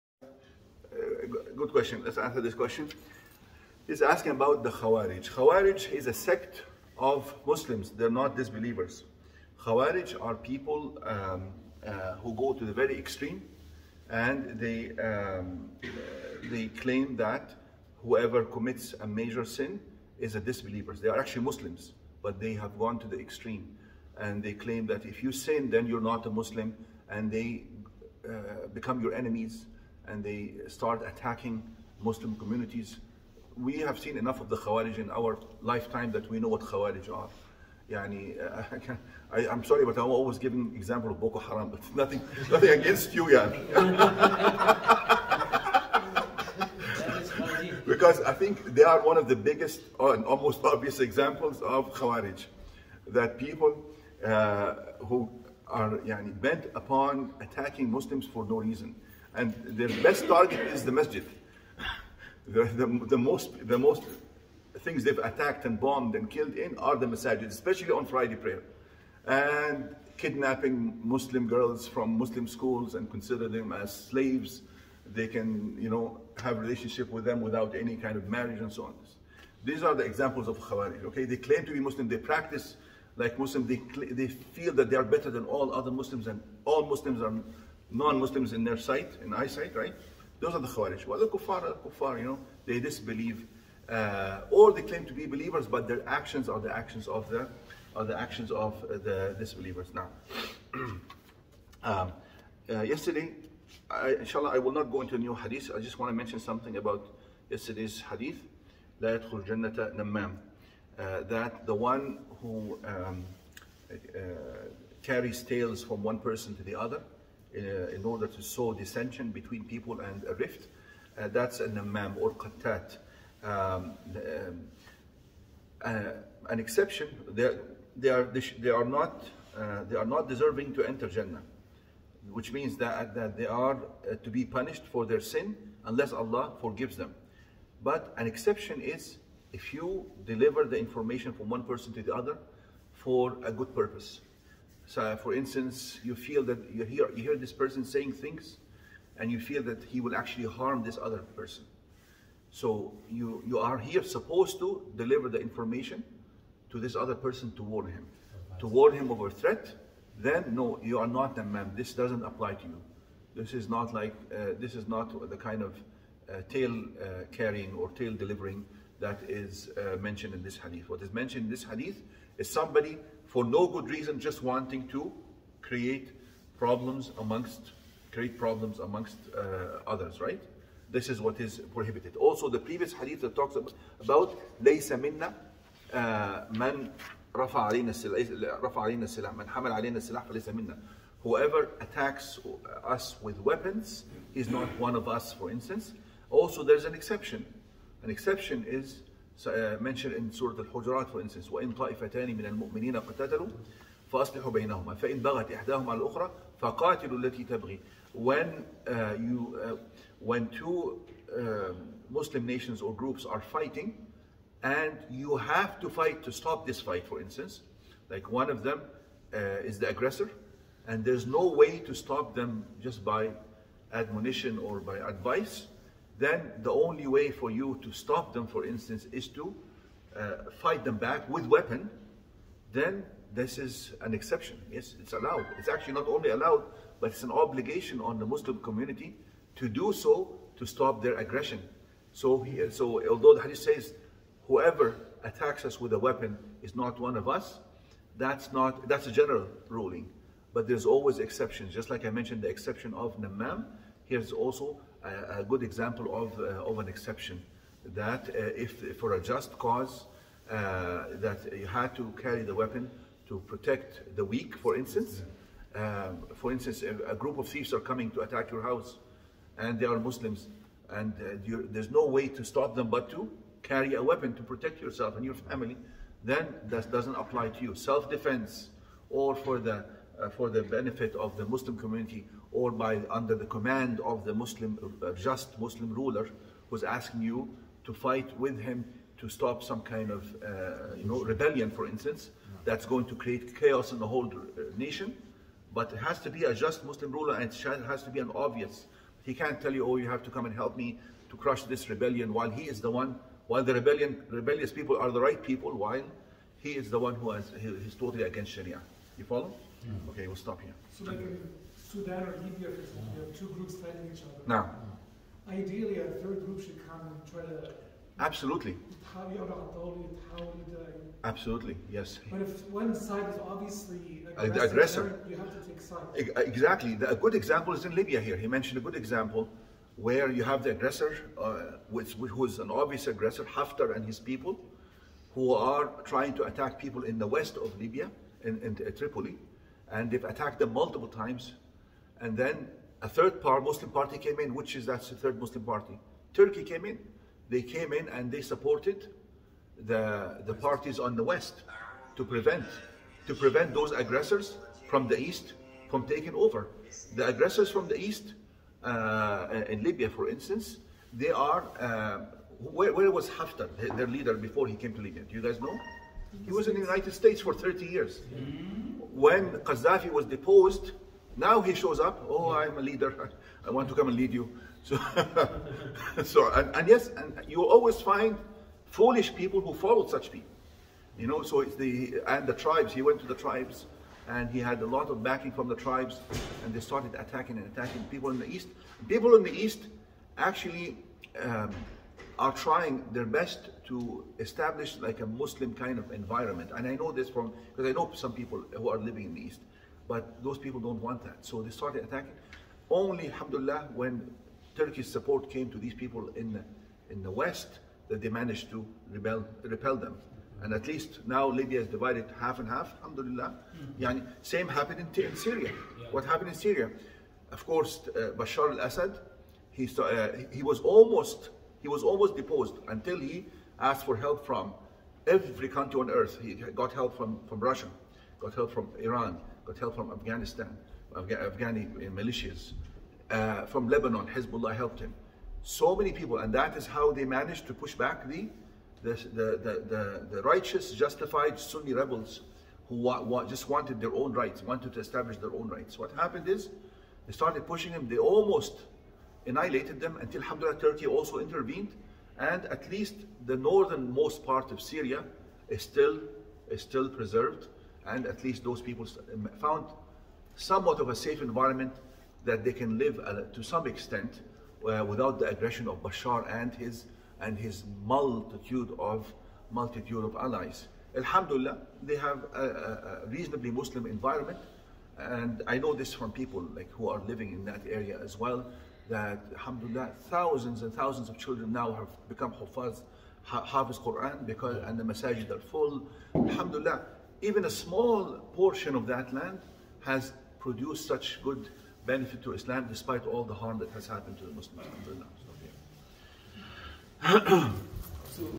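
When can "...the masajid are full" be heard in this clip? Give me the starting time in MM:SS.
08:04.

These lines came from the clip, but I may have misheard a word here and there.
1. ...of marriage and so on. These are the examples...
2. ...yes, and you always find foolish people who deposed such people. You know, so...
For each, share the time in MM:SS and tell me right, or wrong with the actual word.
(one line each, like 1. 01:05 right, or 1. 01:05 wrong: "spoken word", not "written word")
1. 01:18 right
2. 06:16 wrong: "followed", not "deposed".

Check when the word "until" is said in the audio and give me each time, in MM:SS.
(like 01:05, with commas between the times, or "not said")
07:02, 07:30.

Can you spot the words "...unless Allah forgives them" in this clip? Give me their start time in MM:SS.
02:15.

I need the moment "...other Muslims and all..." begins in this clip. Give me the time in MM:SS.
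01:25.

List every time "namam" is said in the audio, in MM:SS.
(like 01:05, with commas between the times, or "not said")
02:01, 04:13.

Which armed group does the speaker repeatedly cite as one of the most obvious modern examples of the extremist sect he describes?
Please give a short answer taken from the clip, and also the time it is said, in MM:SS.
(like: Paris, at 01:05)
Boko Haram, at 00:41.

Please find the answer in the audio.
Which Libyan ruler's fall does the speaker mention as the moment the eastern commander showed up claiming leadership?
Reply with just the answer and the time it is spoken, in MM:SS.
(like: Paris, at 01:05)
Qaddafi, at 06:09.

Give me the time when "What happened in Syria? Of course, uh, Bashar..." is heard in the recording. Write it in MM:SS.
06:56.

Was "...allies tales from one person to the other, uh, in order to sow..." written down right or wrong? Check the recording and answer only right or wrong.
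wrong.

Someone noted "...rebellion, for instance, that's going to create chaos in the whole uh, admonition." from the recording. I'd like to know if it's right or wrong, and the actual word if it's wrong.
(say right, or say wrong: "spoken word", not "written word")
wrong: "nation", not "admonition".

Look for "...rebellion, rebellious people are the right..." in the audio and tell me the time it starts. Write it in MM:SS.
05:03.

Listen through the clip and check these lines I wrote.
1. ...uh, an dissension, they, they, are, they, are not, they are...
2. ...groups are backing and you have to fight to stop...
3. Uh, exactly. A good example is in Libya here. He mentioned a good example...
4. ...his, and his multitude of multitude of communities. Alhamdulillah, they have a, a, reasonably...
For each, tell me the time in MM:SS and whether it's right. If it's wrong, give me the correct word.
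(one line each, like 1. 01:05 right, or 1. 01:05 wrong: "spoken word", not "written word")
1. 02:05 wrong: "exception", not "dissension"
2. 03:32 wrong: "fighting", not "backing"
3. 05:26 right
4. 07:46 wrong: "allies", not "communities".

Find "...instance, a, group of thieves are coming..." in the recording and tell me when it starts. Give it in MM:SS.
04:26.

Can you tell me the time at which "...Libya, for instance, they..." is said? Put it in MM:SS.
05:59.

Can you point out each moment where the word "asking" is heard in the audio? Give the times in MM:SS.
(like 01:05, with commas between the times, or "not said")
00:04, 04:46.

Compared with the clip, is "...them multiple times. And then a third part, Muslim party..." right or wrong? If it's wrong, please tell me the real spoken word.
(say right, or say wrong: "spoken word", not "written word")
right.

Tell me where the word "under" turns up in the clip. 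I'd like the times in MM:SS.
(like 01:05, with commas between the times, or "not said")
04:43.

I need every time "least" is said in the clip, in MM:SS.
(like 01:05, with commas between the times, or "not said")
06:50, 07:32, 07:38.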